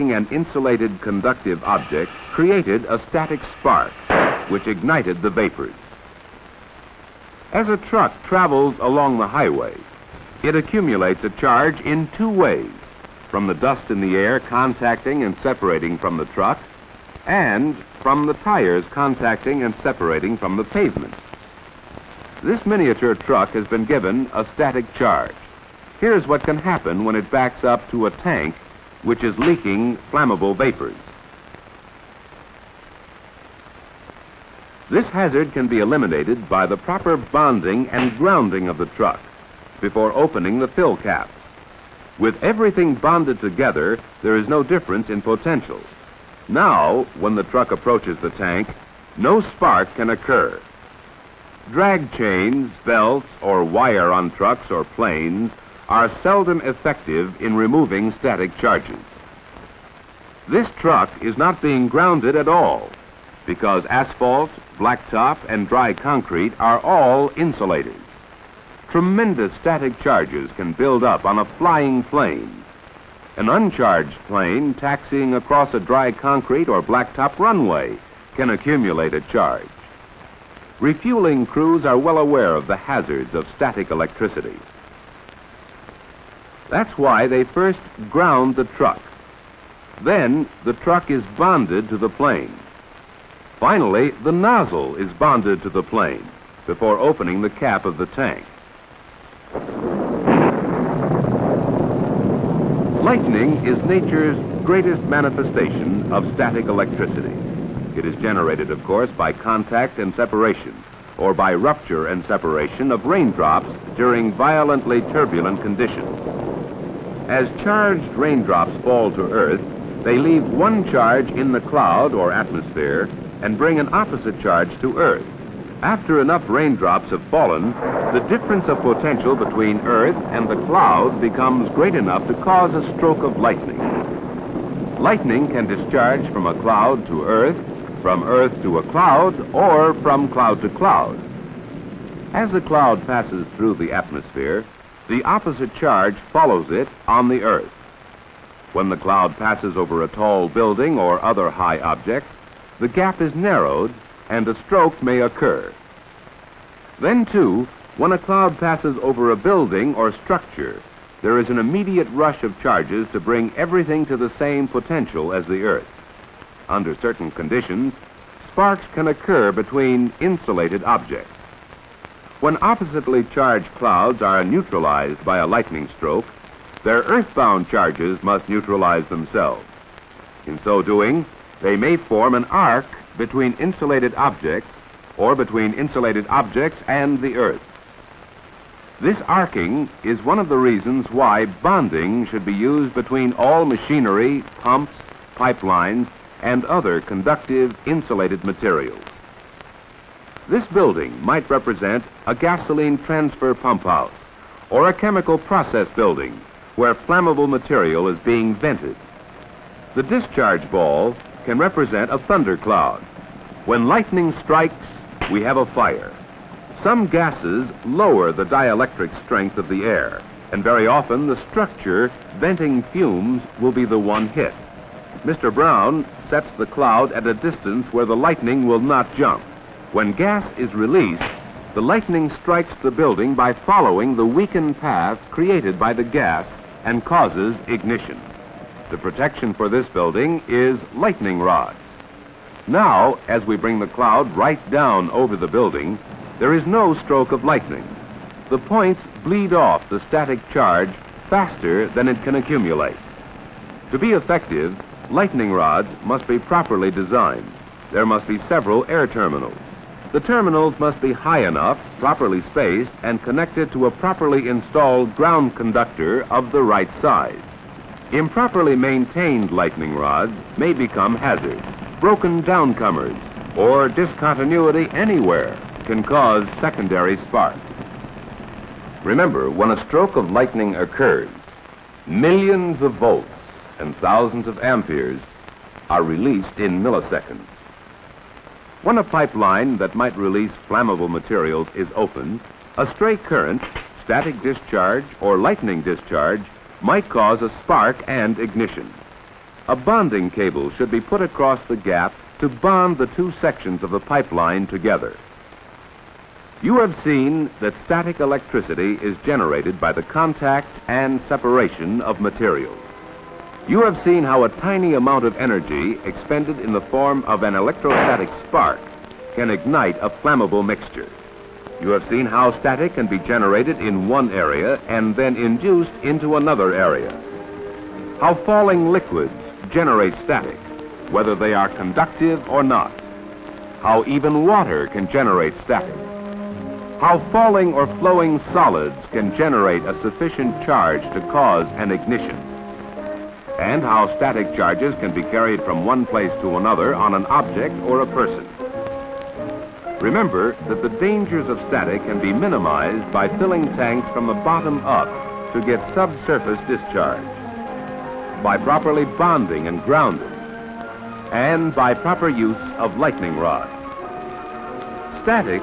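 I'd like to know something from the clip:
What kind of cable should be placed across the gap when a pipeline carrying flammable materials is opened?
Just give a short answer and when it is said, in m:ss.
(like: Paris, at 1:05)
bonding cable, at 4:59.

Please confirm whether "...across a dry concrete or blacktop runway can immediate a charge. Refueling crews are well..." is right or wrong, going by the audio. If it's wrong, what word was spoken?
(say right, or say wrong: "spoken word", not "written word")
wrong: "accumulate", not "immediate".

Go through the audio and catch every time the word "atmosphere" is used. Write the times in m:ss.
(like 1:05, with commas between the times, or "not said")
2:02, 2:23.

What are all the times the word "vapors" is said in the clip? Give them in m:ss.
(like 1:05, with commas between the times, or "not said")
0:05, 0:30.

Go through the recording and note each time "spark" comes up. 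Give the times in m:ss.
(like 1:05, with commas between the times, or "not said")
0:03, 0:49, 2:48, 4:37, 4:57, 5:18.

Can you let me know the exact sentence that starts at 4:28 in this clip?
Improperly maintained lightning rods may become hazards.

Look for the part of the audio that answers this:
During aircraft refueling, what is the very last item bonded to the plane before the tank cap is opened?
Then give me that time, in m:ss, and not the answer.
1:34.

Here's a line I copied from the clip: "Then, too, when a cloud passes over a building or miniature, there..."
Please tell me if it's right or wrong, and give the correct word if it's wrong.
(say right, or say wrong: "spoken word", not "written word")
wrong: "structure", not "miniature".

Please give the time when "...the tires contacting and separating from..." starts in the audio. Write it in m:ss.
0:18.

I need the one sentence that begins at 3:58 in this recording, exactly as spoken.
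The protection for this building is lightning rods.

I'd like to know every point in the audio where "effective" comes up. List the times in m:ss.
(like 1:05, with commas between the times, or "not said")
0:56, 4:14.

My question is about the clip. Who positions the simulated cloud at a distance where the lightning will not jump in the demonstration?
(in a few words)
Mr. Brown.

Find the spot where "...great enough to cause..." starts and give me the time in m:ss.
2:11.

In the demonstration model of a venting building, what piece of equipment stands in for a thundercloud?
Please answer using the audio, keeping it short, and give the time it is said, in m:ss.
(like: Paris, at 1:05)
discharge ball, at 3:29.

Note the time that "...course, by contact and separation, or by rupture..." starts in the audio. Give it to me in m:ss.
1:48.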